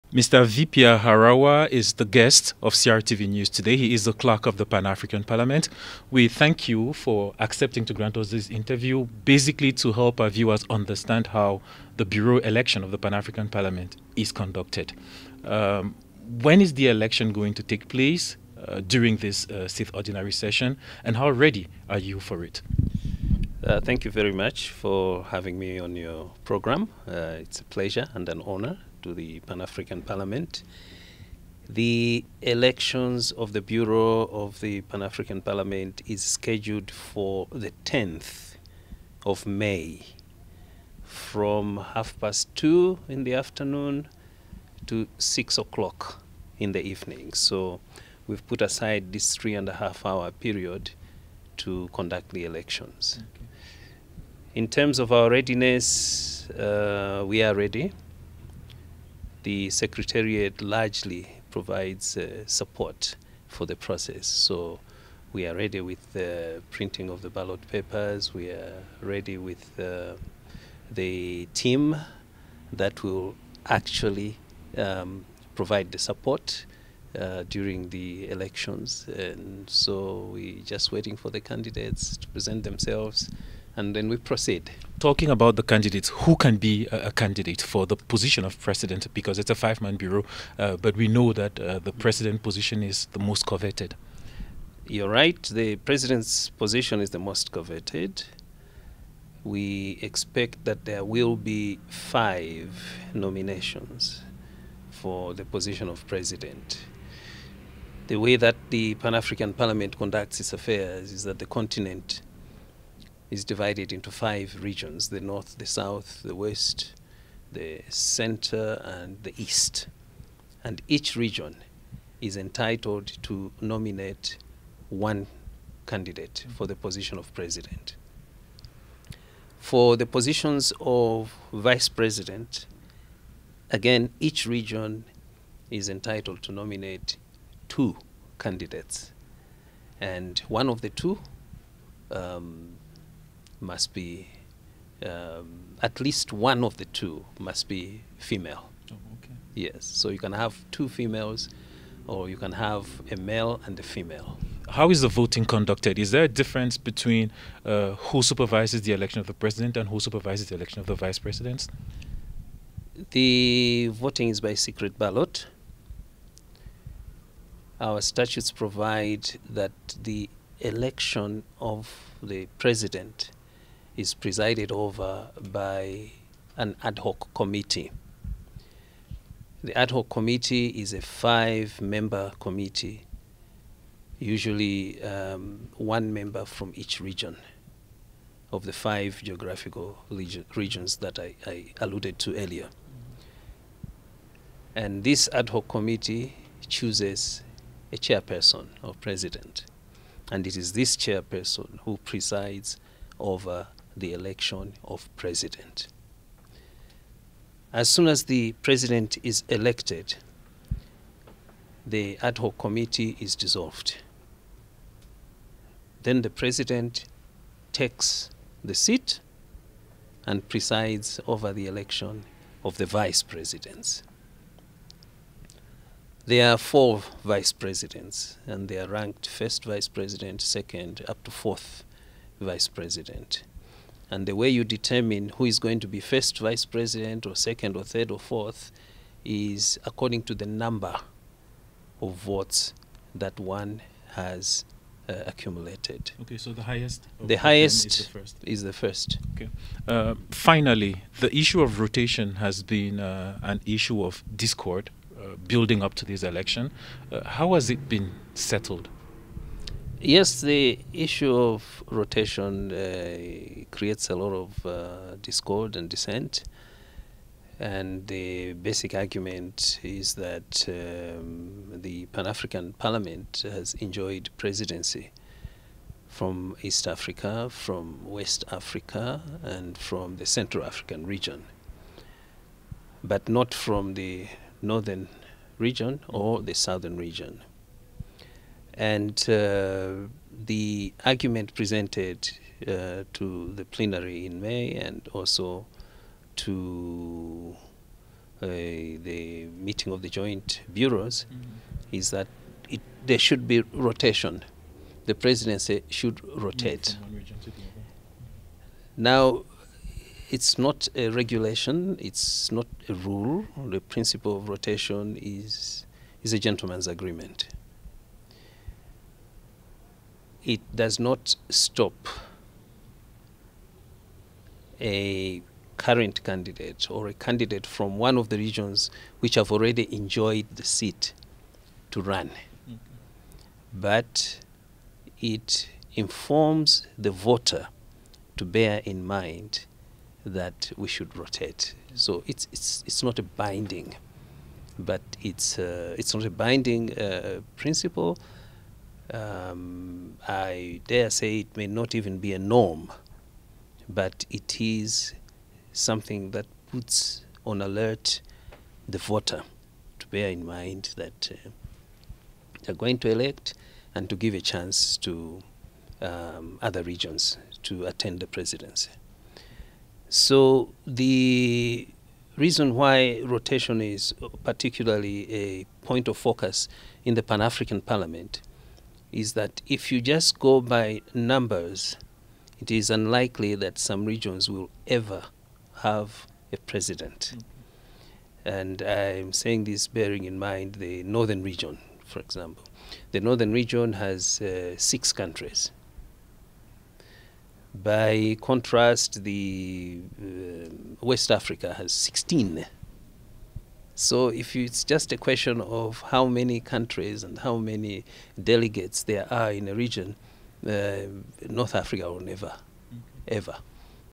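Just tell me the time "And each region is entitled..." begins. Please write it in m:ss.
2:00.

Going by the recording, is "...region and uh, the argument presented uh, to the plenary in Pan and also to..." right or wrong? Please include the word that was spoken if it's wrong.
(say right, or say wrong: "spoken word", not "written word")
wrong: "May", not "Pan".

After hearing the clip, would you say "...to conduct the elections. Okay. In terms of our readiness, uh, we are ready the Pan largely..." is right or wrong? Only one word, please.
wrong.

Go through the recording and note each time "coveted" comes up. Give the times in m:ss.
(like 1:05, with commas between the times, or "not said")
1:33, 1:37.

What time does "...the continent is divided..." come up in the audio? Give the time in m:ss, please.
1:51.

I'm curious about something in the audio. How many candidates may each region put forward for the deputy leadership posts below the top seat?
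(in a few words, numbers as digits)
2.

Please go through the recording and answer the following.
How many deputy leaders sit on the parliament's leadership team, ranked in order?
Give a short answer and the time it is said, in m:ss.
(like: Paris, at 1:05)
4, at 3:46.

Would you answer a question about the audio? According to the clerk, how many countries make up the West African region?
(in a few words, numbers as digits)
16.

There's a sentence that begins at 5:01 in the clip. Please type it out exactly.
is that it, there should be rotation.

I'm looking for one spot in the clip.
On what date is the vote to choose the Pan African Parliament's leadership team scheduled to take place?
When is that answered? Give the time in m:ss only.
0:37.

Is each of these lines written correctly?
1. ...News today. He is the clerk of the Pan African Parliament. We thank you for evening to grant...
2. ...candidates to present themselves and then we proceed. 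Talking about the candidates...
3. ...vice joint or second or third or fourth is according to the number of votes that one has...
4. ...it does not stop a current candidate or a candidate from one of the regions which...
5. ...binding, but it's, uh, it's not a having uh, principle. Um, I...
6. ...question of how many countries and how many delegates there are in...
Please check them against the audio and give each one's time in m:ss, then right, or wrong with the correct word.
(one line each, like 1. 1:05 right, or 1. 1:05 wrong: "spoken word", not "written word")
1. 0:03 wrong: "accepting", not "evening"
2. 1:21 right
3. 3:56 wrong: "president", not "joint"
4. 5:20 right
5. 5:43 wrong: "binding", not "having"
6. 6:45 right.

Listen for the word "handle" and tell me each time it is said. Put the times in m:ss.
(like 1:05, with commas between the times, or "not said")
not said.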